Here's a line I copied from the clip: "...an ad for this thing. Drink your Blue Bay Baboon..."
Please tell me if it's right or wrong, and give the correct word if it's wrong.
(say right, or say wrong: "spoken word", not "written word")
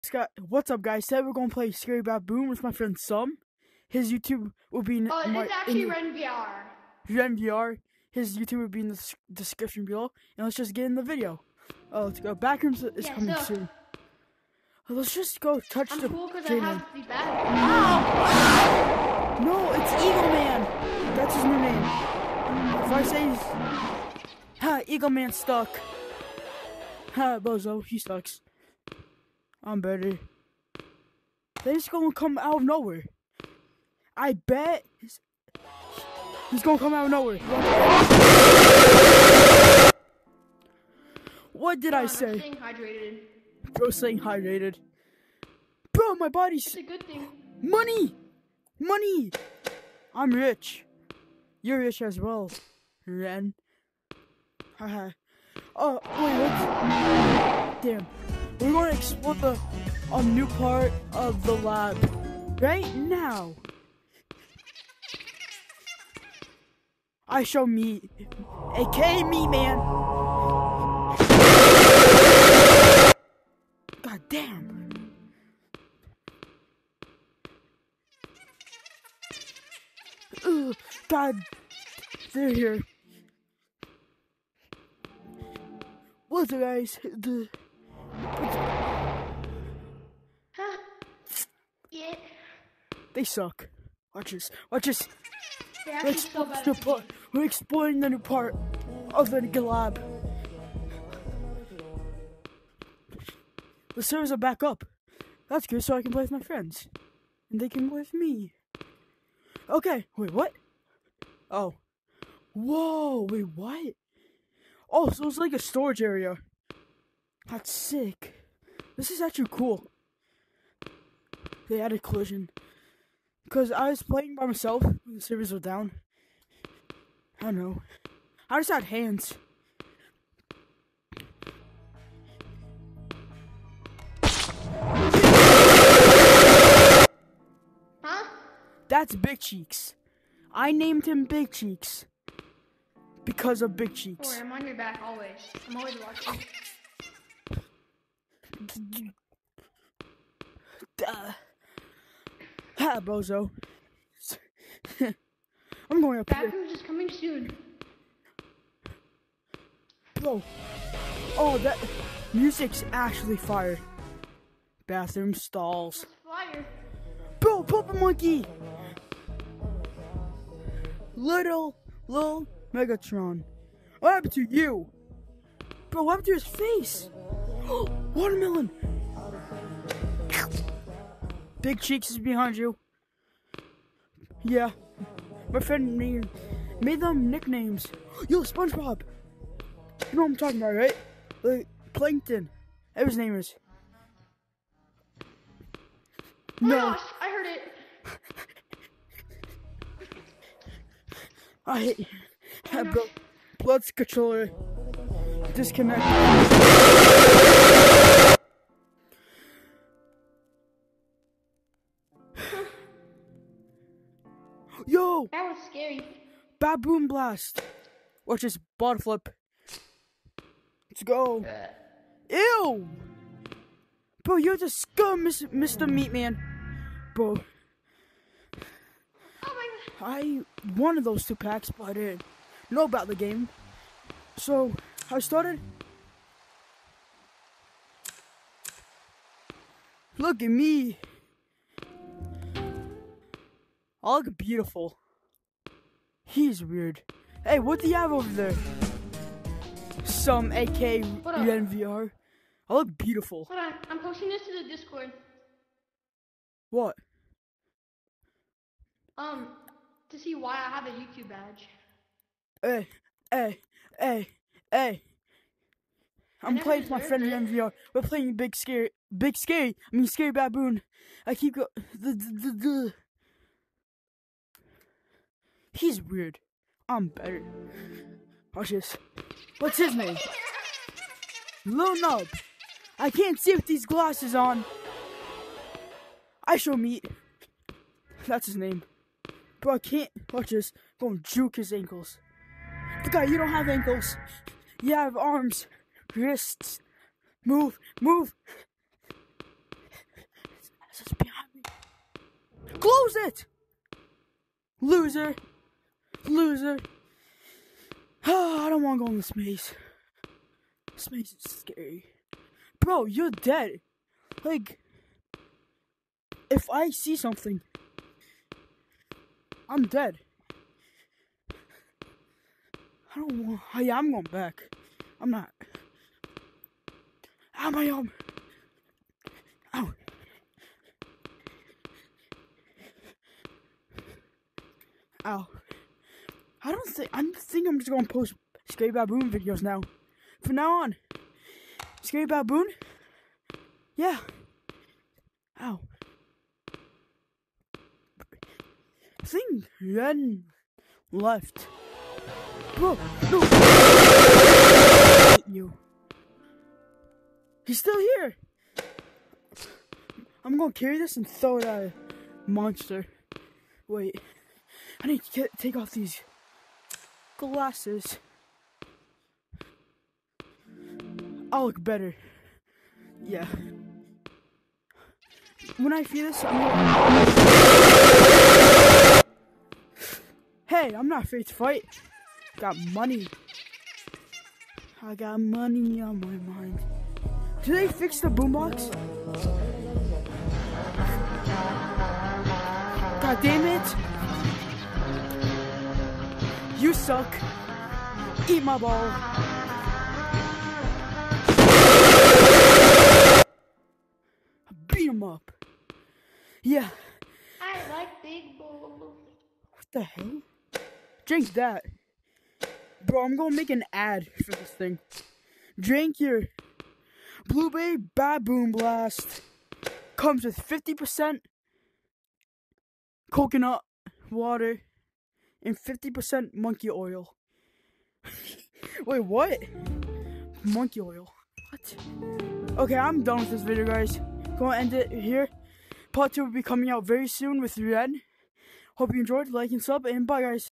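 right.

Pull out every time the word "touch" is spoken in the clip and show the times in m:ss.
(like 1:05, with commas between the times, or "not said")
0:15.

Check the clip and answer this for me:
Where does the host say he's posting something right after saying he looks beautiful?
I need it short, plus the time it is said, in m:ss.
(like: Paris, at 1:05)
Discord, at 4:14.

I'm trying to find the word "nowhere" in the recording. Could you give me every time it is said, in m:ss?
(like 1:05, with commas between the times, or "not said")
0:32, 0:37.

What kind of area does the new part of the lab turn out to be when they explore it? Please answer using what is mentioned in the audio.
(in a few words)
storage area.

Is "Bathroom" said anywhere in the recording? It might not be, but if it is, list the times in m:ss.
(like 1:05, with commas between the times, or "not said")
2:36, 2:44.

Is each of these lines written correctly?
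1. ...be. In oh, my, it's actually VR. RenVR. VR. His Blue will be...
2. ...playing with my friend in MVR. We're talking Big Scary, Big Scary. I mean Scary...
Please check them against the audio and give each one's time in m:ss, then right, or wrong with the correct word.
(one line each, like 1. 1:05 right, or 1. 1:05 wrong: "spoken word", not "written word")
1. 0:04 wrong: "YouTube", not "Blue"
2. 4:26 wrong: "playing", not "talking".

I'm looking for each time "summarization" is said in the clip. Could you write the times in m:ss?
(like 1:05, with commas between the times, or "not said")
not said.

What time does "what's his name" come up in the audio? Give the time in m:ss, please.
4:39.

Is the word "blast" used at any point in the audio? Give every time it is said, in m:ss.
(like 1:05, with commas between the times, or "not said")
3:37, 6:58.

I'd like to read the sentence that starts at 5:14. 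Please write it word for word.
Like, if I see something, I'm dead.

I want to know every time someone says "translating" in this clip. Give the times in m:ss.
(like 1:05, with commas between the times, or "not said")
not said.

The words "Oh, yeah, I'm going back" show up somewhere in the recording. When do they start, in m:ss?
5:23.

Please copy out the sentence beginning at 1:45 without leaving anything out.
That's good, so I can play with my friends.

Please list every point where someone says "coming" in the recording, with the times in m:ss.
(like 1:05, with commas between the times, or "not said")
0:13, 2:36, 7:16.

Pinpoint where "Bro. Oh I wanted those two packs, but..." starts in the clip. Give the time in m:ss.
3:47.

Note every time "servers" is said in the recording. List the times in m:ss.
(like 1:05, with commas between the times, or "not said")
1:44, 2:05.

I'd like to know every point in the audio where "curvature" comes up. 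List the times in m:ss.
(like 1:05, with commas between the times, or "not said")
not said.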